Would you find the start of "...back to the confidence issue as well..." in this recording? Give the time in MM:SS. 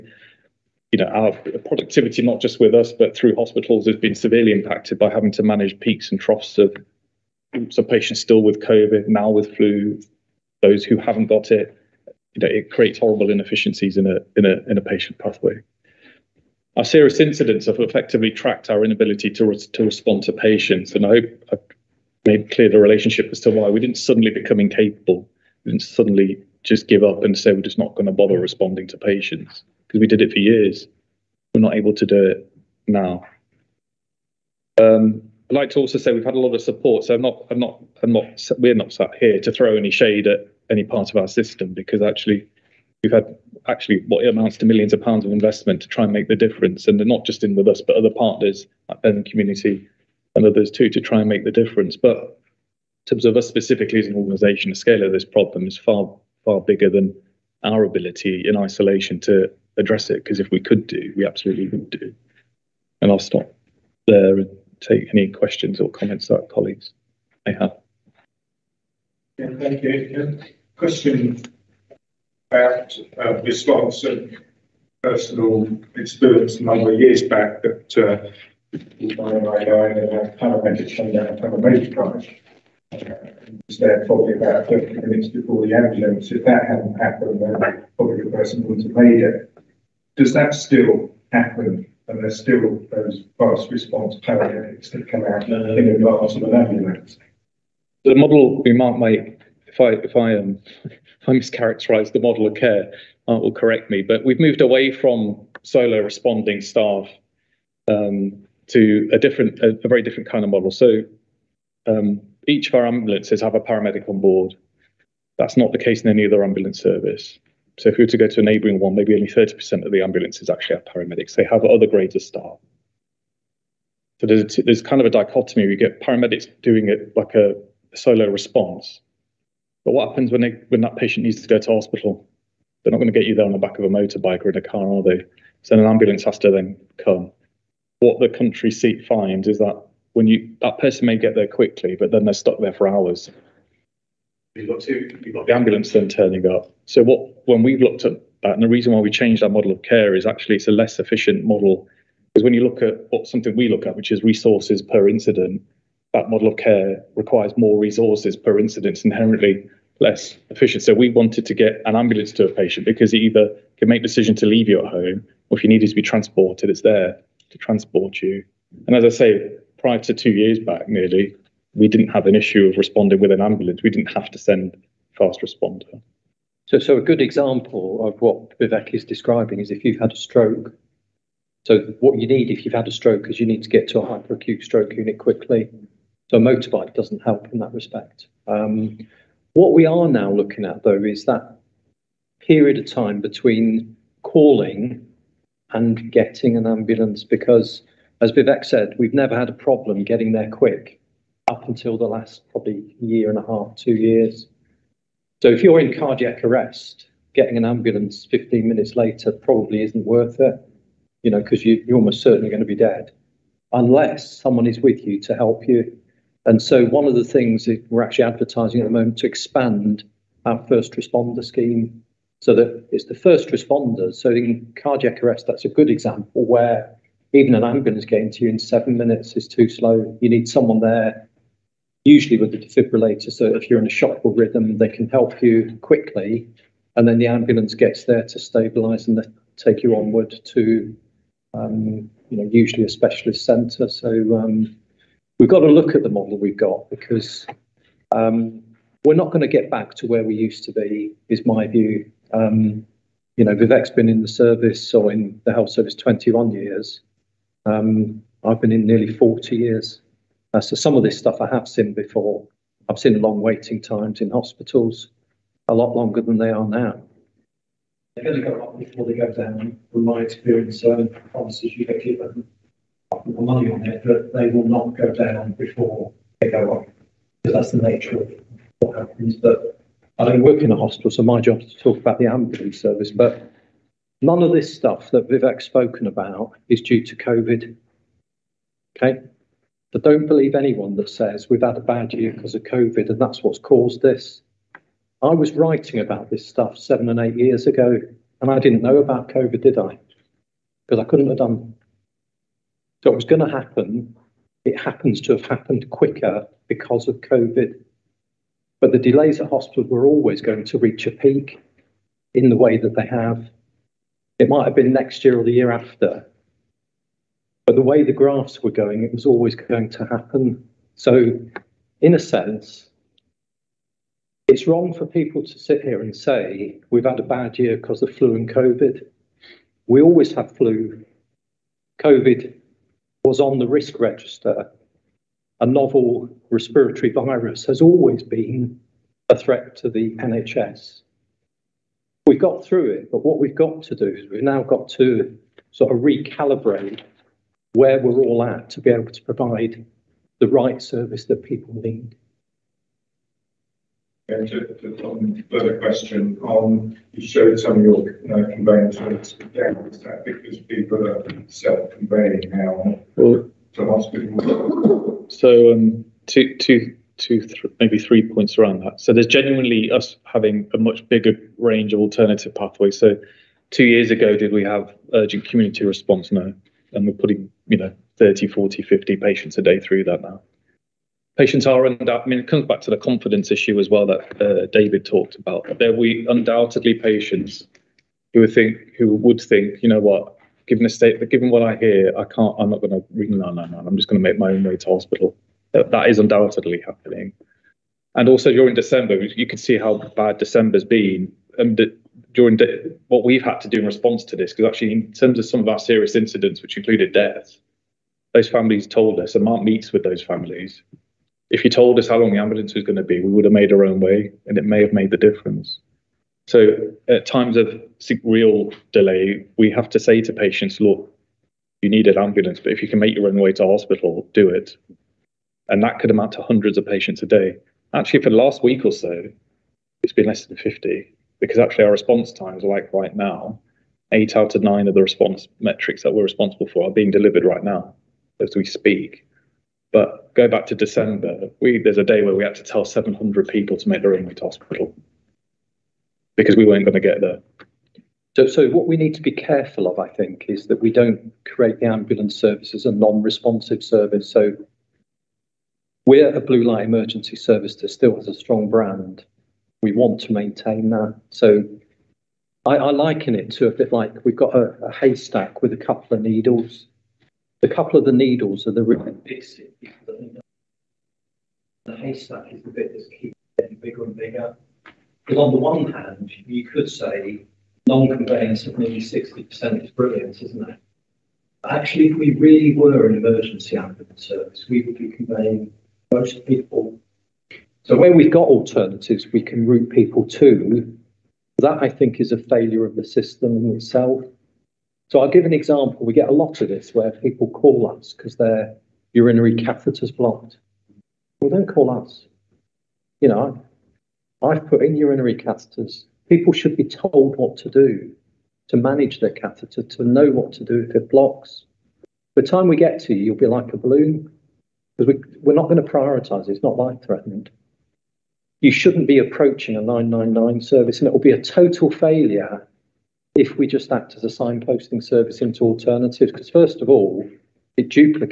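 06:22.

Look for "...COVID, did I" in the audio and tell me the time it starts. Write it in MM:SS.
04:59.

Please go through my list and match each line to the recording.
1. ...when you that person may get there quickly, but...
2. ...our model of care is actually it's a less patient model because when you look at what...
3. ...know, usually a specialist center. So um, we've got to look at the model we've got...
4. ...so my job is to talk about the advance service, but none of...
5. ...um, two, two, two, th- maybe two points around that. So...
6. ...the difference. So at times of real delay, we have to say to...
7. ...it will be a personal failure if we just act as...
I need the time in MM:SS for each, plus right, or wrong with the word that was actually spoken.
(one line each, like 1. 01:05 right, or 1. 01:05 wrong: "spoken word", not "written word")
1. 02:20 right
2. 02:29 wrong: "efficient", not "patient"
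3. 04:02 right
4. 04:41 wrong: "ambulance", not "advance"
5. 06:05 wrong: "three", not "two"
6. 06:55 right
7. 08:41 wrong: "total", not "personal".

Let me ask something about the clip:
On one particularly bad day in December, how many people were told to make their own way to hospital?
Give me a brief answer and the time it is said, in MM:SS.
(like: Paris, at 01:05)
700, at 07:22.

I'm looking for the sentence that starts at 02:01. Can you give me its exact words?
They have other grades of staff.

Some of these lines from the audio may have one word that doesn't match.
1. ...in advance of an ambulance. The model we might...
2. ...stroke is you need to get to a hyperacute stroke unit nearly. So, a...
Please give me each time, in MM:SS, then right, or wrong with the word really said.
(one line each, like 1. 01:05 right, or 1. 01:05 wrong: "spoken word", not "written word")
1. 01:35 right
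2. 03:02 wrong: "quickly", not "nearly".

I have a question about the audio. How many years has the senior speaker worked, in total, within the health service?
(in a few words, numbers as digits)
nearly 40 years.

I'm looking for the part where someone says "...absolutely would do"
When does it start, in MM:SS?
01:01.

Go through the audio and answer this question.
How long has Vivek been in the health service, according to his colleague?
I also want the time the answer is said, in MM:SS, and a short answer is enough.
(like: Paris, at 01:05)
21 years, at 04:15.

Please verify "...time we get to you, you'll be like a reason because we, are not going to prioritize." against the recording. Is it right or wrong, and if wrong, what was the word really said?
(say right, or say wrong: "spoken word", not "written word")
wrong: "balloon", not "reason".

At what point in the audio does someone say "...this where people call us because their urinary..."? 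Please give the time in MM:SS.
08:16.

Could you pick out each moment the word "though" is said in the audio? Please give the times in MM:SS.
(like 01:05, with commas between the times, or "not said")
03:10.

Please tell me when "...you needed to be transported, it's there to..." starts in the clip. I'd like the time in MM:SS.
02:45.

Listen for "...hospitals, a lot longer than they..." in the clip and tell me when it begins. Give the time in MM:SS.
04:24.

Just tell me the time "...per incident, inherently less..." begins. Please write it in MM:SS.
02:38.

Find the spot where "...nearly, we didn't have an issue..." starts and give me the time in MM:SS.
02:50.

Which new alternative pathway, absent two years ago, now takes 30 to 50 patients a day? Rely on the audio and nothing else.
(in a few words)
urgent community response.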